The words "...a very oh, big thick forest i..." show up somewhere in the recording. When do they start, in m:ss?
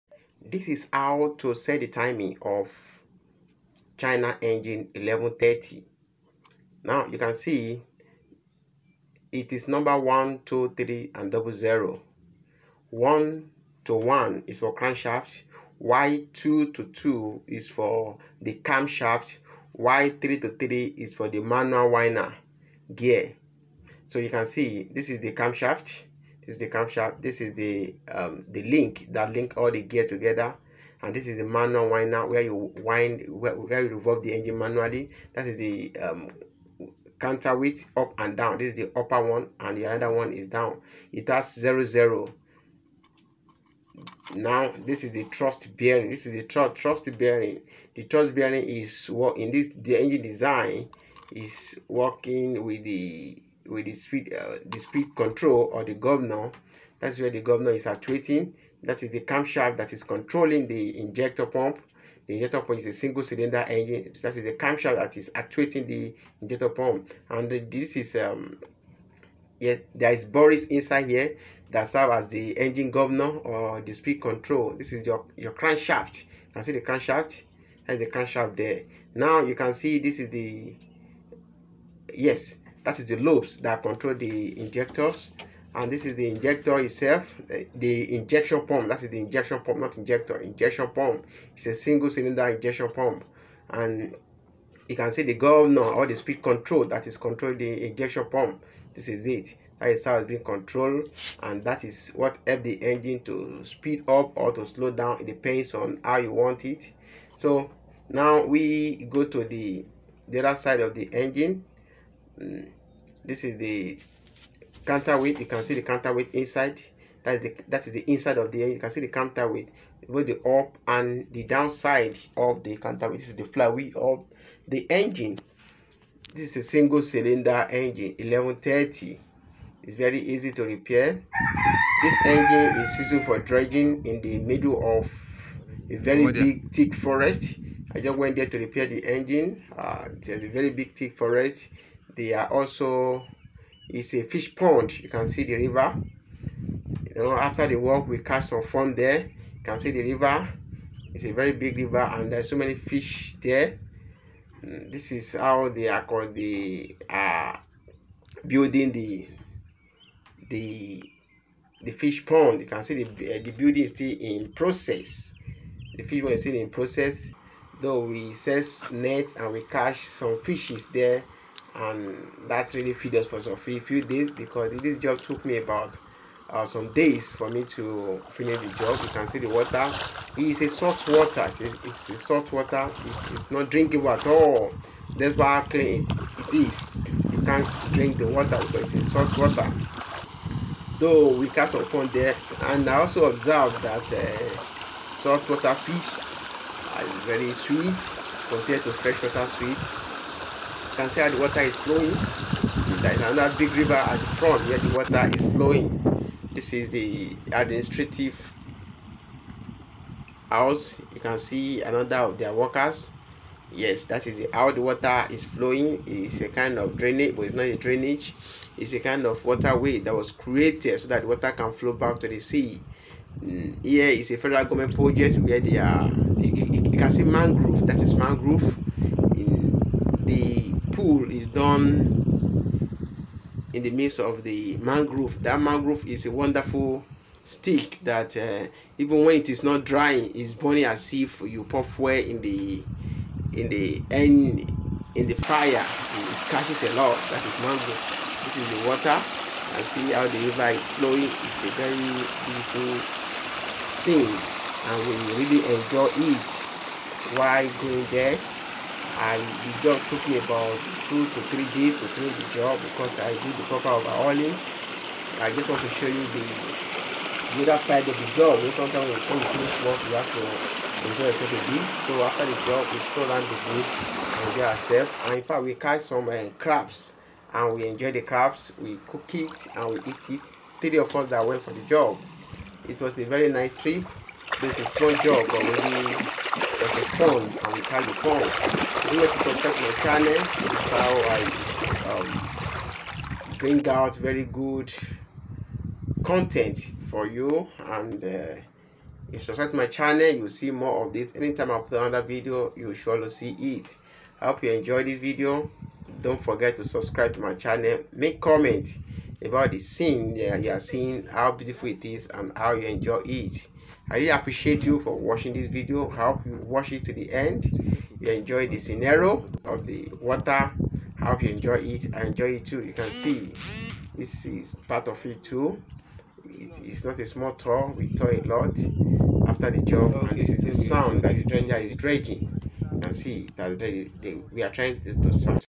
2:15.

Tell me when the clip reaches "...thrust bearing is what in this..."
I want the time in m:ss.
0:48.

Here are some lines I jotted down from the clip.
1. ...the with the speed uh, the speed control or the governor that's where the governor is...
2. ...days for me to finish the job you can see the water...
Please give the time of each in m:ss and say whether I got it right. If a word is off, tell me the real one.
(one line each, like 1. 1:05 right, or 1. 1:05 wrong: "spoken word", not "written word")
1. 0:52 right
2. 2:56 right.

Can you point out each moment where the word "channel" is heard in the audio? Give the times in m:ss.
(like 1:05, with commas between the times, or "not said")
4:50, 4:59, 5:07.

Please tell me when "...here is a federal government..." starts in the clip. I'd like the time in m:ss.
3:43.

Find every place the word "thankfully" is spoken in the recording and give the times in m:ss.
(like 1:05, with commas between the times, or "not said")
not said.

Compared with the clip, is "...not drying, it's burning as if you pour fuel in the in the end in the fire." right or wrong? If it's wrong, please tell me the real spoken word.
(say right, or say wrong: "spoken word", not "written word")
right.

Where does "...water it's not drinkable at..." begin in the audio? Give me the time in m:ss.
3:02.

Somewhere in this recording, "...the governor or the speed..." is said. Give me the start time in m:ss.
1:35.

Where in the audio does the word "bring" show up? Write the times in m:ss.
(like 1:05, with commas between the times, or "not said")
4:53.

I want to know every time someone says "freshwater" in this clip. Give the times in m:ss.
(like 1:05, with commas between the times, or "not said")
3:18.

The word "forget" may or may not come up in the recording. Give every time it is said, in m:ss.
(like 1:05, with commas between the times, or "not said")
5:06.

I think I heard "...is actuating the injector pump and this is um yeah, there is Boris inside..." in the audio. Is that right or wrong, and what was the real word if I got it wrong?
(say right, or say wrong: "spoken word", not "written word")
right.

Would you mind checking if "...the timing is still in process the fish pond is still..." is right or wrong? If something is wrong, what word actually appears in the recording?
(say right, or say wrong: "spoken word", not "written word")
wrong: "building", not "timing".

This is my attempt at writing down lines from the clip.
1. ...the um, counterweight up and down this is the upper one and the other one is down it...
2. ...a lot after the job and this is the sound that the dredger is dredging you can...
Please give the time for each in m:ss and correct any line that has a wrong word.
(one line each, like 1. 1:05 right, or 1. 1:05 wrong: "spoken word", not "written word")
1. 0:35 right
2. 5:28 right.